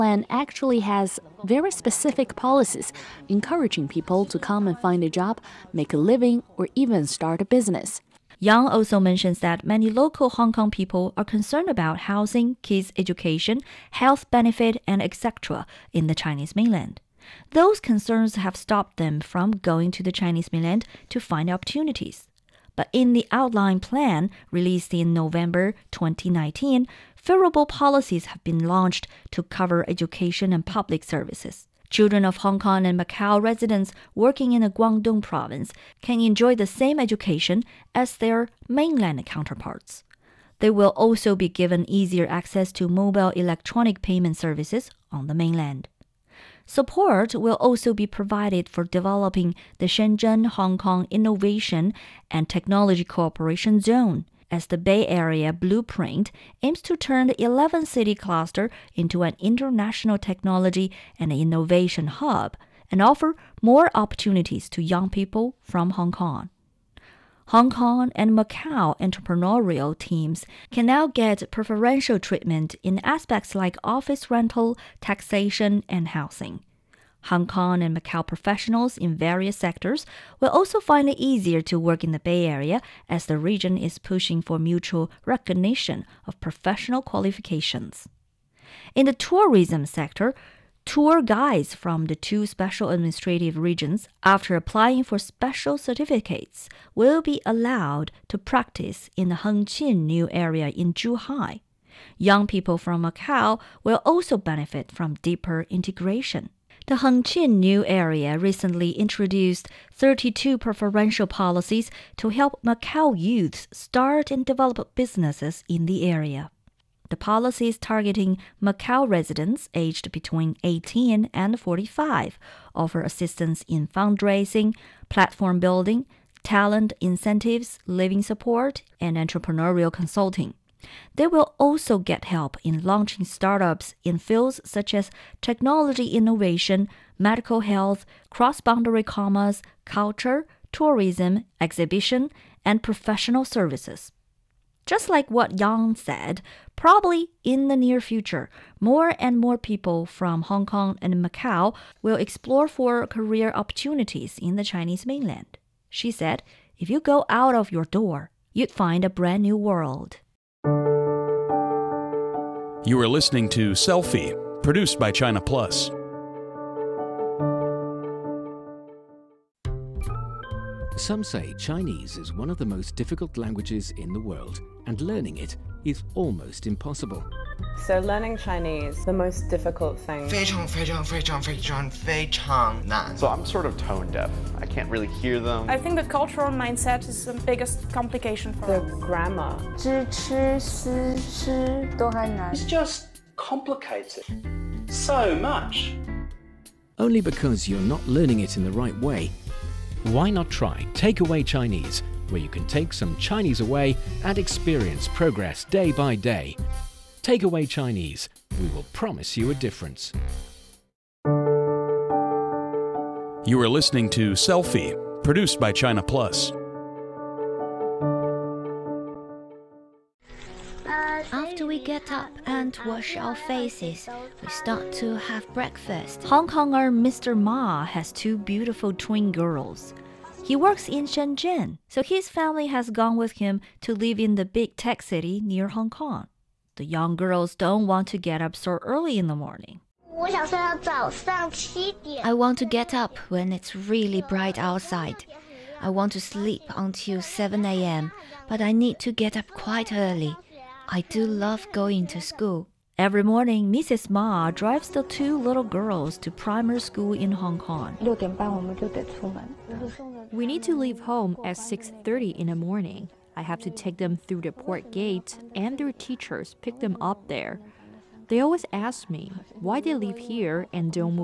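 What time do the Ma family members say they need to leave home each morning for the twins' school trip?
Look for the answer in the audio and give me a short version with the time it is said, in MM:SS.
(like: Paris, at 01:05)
6:30, at 04:21.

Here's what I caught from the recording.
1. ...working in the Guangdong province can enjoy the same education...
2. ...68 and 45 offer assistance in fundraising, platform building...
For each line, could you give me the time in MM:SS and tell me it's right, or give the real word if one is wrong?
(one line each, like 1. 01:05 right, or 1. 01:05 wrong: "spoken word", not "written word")
1. 00:34 right
2. 02:00 wrong: "18", not "68".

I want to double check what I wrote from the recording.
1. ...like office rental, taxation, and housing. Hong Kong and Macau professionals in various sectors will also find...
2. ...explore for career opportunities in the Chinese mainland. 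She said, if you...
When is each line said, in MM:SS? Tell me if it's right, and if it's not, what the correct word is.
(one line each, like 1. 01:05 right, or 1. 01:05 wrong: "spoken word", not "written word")
1. 01:13 right
2. 02:32 right.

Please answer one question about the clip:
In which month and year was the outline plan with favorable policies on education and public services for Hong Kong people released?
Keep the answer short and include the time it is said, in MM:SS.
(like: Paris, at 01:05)
November 2019, at 00:25.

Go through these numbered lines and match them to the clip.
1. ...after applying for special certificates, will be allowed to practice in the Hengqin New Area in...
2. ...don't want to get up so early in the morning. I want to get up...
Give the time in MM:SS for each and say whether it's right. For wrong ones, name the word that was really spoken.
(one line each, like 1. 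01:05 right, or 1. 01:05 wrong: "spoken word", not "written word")
1. 01:34 right
2. 03:57 right.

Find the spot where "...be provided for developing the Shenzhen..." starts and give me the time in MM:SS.
00:47.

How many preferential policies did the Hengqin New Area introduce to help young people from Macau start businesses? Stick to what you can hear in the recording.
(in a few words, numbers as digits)
32.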